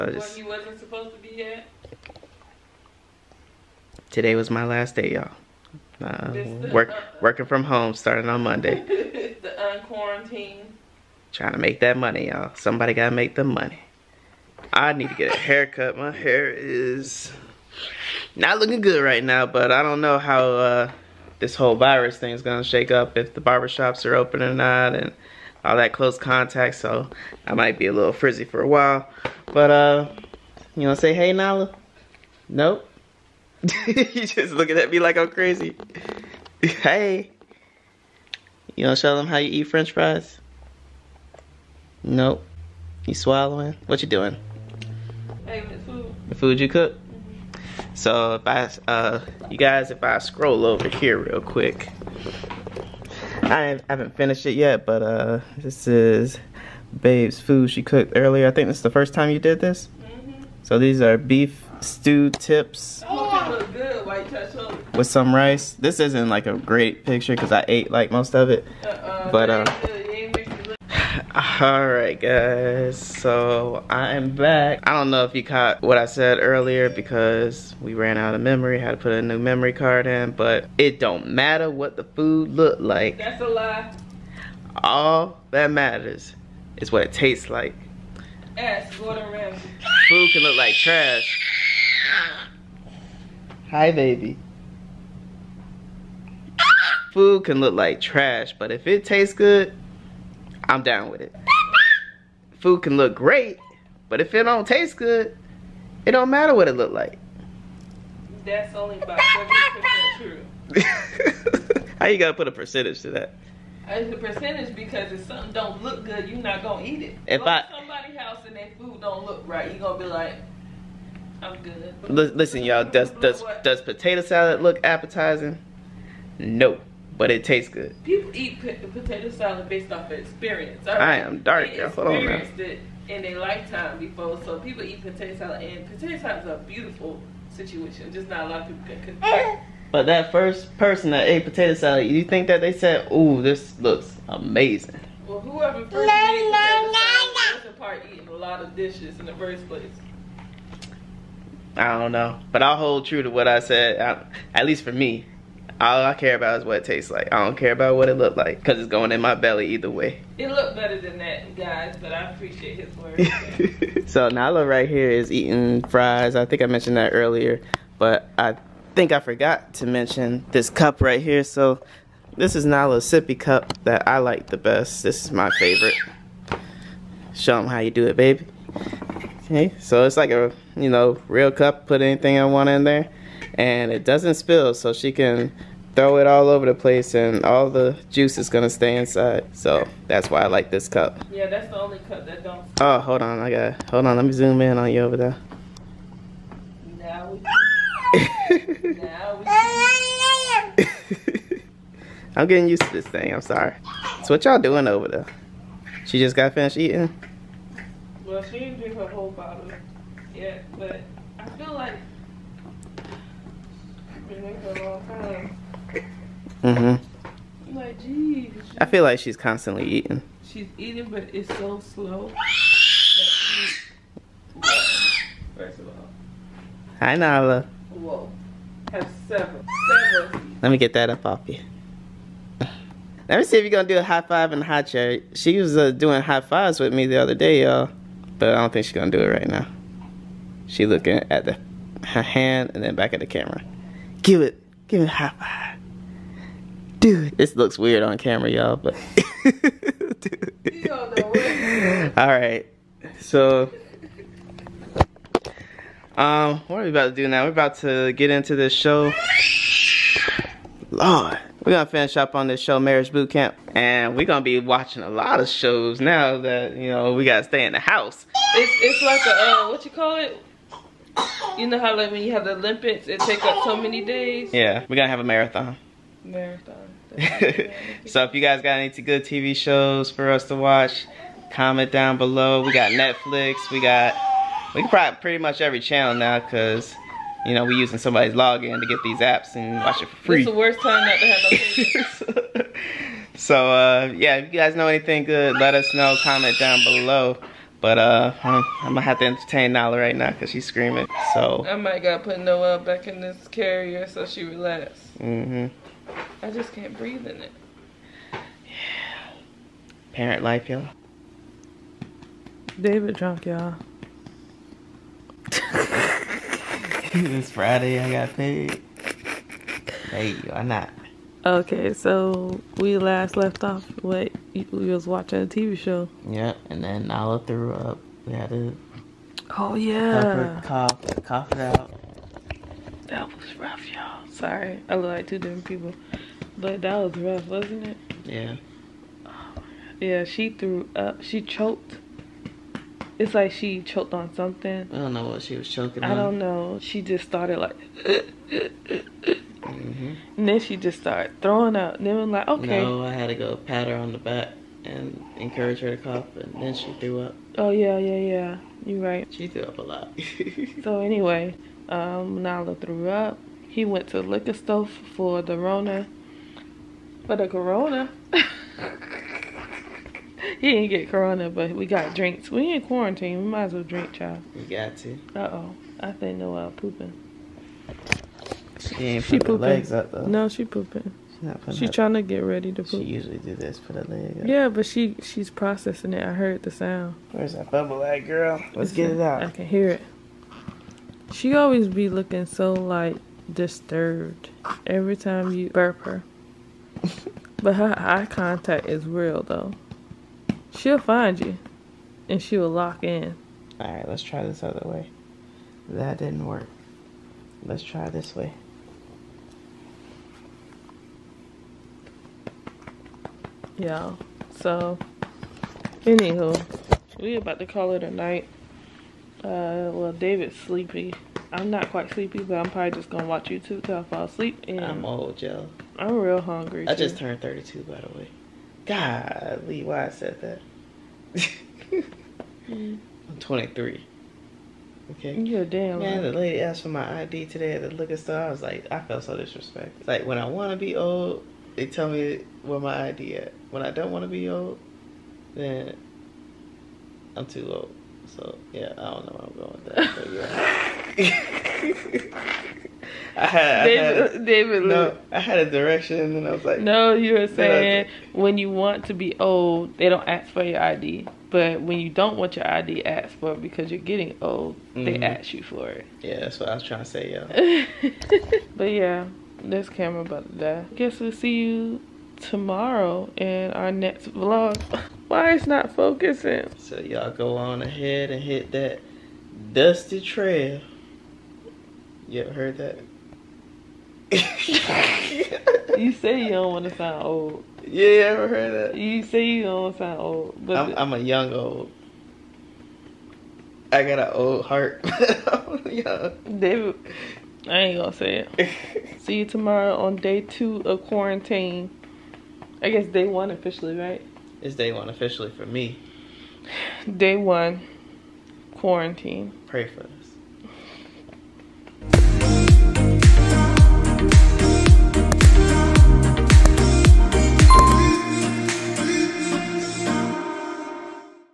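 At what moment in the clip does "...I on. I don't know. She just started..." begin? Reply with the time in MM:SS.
05:46.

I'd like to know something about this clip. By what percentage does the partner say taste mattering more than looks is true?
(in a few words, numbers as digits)
70%.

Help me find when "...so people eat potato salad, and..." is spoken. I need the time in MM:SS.
02:14.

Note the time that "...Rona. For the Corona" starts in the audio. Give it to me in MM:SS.
06:05.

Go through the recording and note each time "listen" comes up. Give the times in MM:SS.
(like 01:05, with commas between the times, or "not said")
02:02, 06:28.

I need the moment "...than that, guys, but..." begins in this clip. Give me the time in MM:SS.
02:40.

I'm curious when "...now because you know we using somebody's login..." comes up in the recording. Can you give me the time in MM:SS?
04:46.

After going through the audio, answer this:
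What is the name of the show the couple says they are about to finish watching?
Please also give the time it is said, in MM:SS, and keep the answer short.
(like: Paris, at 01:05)
Marriage Boot Camp, at 04:22.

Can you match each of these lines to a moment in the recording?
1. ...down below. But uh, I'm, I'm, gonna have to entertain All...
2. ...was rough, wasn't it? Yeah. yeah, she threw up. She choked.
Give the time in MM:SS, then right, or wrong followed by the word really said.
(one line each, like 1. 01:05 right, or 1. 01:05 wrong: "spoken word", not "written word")
1. 04:56 wrong: "Nala", not "All"
2. 05:36 right.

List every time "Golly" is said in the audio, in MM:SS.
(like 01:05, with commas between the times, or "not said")
07:08.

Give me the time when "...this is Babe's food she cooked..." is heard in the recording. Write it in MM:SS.
00:55.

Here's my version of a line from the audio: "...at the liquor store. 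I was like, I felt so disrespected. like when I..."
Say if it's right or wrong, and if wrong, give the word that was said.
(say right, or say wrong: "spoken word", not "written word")
right.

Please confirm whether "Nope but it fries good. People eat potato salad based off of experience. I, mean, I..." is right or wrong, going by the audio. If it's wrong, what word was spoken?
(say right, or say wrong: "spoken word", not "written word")
wrong: "tastes", not "fries".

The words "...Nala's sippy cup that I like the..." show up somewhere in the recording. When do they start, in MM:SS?
02:52.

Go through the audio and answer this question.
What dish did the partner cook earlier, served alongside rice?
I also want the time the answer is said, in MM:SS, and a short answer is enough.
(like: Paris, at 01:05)
beef stew tips, at 01:01.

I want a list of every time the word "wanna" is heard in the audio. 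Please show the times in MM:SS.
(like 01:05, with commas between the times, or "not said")
00:30, 00:38.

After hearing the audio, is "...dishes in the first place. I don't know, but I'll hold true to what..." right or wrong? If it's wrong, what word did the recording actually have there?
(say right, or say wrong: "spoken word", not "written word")
right.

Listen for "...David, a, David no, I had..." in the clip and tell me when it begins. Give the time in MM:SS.
07:33.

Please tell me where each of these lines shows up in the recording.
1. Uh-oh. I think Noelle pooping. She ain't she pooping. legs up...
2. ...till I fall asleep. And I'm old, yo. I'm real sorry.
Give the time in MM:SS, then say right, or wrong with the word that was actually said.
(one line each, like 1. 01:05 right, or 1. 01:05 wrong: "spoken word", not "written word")
1. 06:15 right
2. 07:03 wrong: "hungry", not "sorry".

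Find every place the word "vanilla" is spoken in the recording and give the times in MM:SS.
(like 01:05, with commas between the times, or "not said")
not said.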